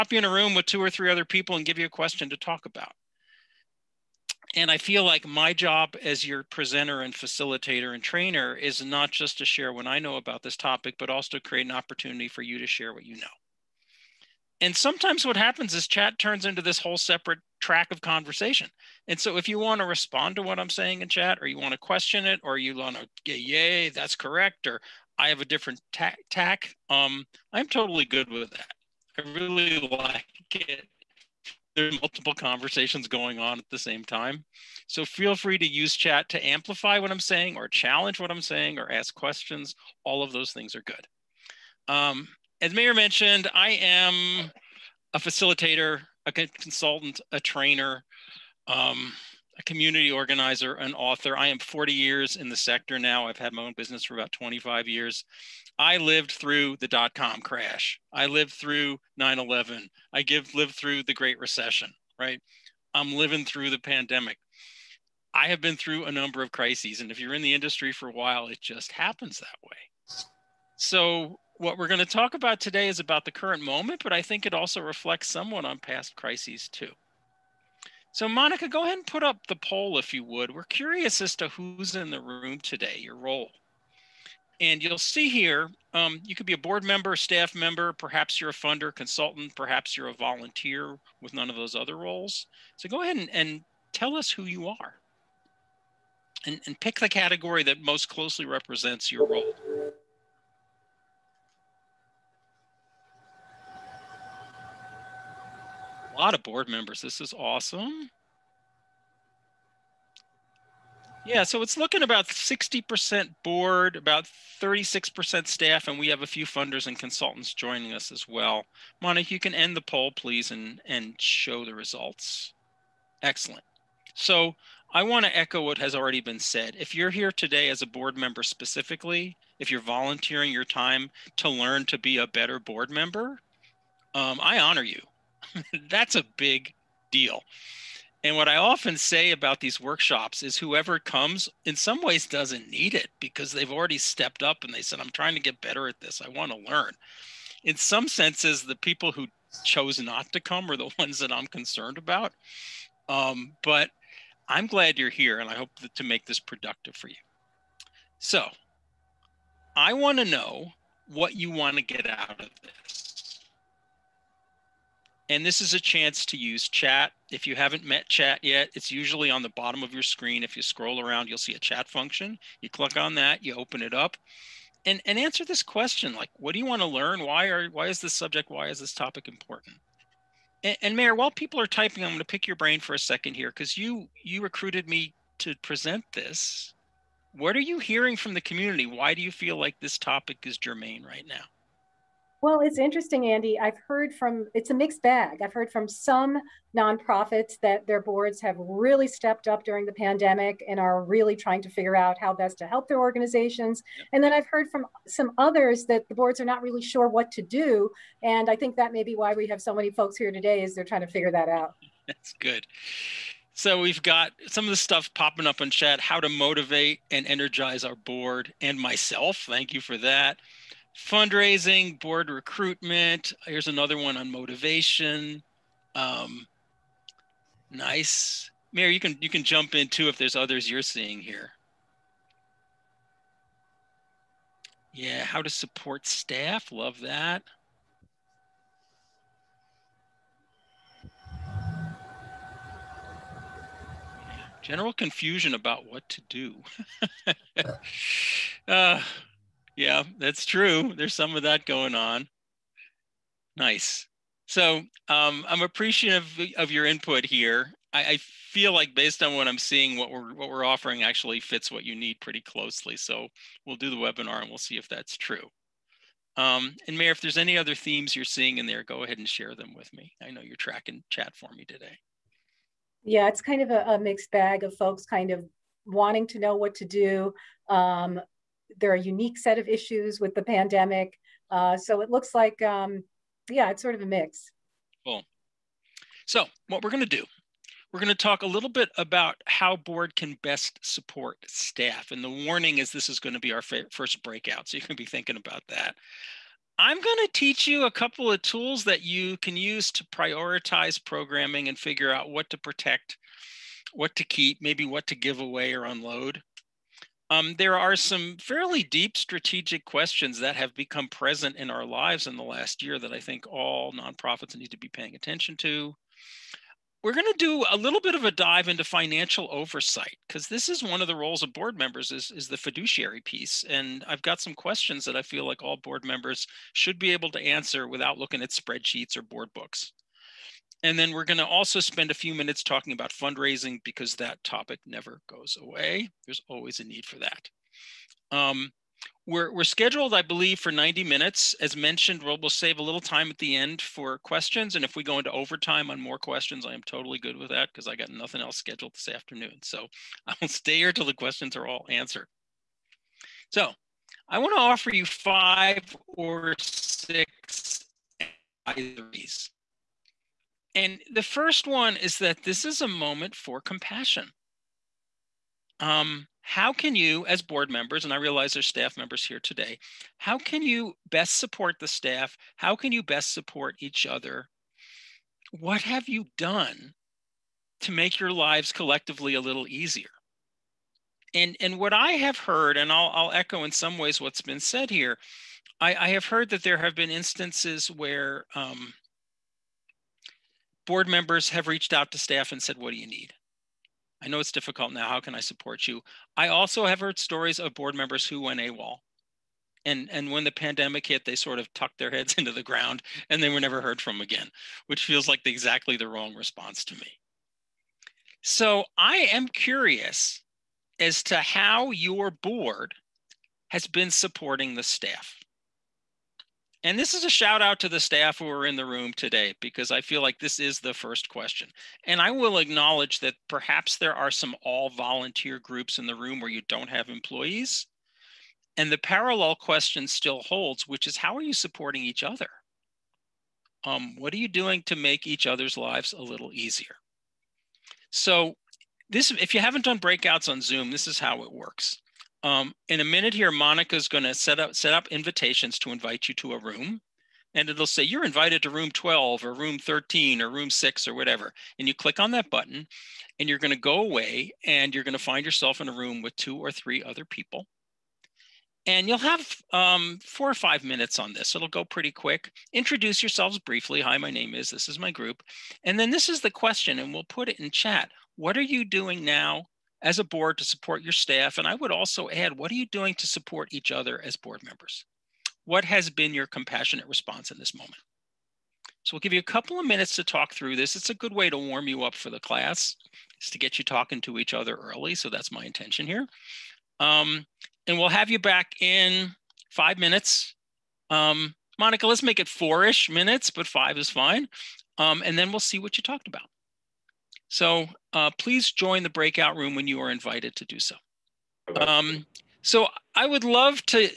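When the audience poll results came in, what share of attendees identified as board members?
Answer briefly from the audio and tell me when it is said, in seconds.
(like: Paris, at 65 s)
60%, at 112 s.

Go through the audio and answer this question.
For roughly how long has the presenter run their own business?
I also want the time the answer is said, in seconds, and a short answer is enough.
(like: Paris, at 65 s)
25 years, at 54 s.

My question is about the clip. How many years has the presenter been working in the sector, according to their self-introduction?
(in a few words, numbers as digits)
40.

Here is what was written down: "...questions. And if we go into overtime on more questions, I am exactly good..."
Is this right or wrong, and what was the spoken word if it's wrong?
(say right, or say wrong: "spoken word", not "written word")
wrong: "totally", not "exactly".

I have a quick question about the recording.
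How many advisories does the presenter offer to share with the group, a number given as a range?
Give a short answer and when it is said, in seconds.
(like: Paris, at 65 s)
5 or 6, at 355 s.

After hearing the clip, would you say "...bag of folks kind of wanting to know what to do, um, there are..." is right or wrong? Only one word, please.
right.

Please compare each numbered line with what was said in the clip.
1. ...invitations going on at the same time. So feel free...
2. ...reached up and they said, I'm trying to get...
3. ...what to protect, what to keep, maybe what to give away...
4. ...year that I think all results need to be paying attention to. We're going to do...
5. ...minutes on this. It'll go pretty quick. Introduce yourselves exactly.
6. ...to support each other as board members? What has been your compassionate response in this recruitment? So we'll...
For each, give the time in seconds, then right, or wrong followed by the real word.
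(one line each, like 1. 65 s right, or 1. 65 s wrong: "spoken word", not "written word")
1. 32 s wrong: "conversations", not "invitations"
2. 143 s wrong: "stepped", not "reached"
3. 302 s right
4. 312 s wrong: "nonprofits", not "results"
5. 460 s wrong: "briefly", not "exactly"
6. 473 s wrong: "moment", not "recruitment".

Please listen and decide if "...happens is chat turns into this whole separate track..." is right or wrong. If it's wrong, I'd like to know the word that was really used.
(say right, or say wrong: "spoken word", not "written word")
right.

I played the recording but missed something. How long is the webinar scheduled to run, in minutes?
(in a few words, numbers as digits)
90 minutes.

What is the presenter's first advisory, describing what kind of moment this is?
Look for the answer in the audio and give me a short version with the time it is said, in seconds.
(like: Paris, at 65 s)
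compassion, at 363 s.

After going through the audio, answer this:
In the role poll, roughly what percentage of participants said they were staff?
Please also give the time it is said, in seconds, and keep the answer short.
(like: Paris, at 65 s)
36%, at 114 s.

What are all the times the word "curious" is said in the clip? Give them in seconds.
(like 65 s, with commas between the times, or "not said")
80 s, 409 s.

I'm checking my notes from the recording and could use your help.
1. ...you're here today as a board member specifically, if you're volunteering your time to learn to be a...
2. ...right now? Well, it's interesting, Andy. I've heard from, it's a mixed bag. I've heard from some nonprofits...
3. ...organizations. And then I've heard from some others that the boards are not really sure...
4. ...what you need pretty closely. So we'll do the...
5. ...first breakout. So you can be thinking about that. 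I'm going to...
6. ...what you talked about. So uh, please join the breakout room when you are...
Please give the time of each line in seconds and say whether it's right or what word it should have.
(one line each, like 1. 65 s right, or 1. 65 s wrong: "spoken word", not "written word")
1. 126 s right
2. 191 s right
3. 202 s right
4. 261 s right
5. 293 s right
6. 495 s right.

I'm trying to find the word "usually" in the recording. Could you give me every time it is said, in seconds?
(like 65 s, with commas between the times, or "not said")
168 s.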